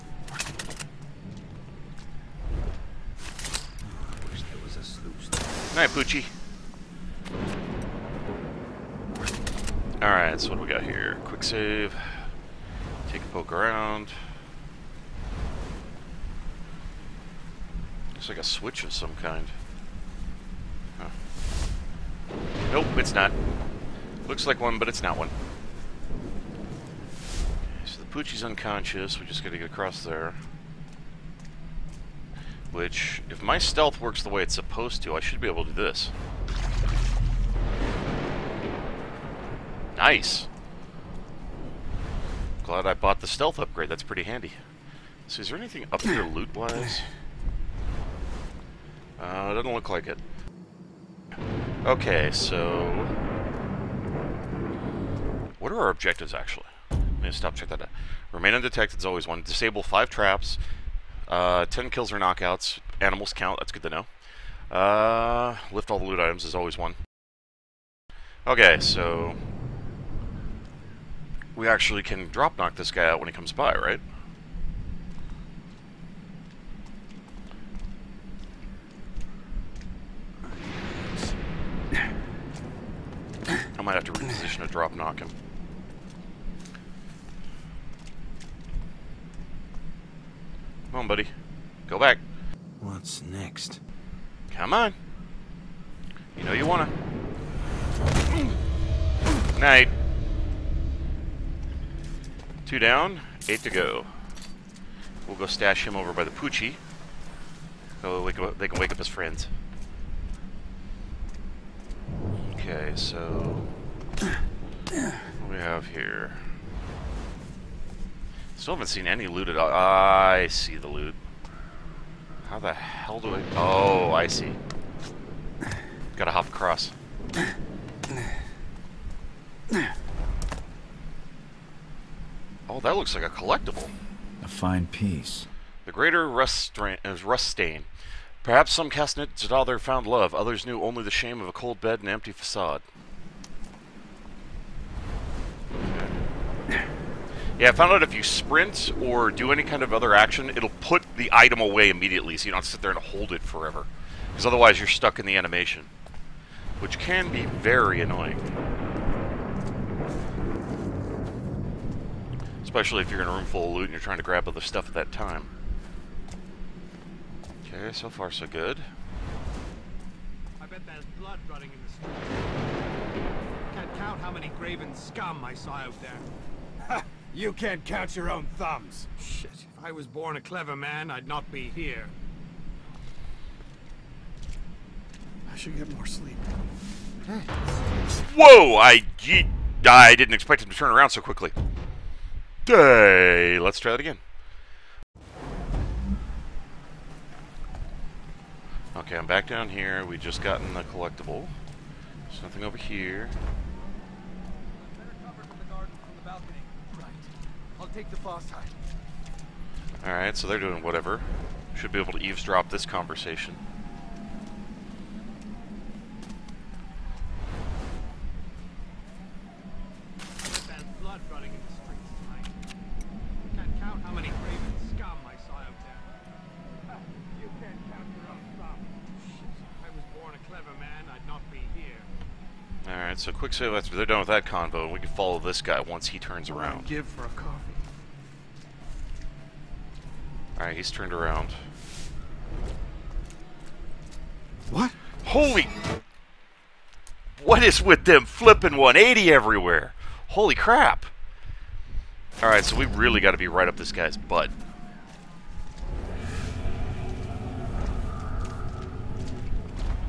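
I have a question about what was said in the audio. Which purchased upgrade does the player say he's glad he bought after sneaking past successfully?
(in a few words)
Stealth upgrade.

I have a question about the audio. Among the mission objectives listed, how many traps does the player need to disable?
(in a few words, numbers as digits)
5.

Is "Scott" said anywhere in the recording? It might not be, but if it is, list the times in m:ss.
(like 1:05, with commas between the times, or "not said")
not said.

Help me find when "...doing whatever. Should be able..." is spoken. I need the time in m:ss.
3:30.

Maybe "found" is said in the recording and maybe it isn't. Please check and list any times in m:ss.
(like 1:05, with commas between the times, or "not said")
2:19, 2:27.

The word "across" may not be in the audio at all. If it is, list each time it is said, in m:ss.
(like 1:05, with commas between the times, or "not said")
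0:29, 2:06.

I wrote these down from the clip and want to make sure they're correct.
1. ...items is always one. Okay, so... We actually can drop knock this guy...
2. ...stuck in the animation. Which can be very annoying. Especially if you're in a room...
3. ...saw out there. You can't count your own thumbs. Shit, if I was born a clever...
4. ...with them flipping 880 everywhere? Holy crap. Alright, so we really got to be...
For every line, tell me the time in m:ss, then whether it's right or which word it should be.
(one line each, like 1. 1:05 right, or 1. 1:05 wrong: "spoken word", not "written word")
1. 1:06 right
2. 2:34 right
3. 2:55 right
4. 4:07 wrong: "180", not "880".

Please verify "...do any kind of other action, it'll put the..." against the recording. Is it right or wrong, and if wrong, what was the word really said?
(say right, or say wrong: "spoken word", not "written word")
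right.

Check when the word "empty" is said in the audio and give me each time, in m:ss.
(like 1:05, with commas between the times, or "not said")
2:22.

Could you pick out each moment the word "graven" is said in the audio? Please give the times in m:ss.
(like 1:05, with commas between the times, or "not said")
2:54.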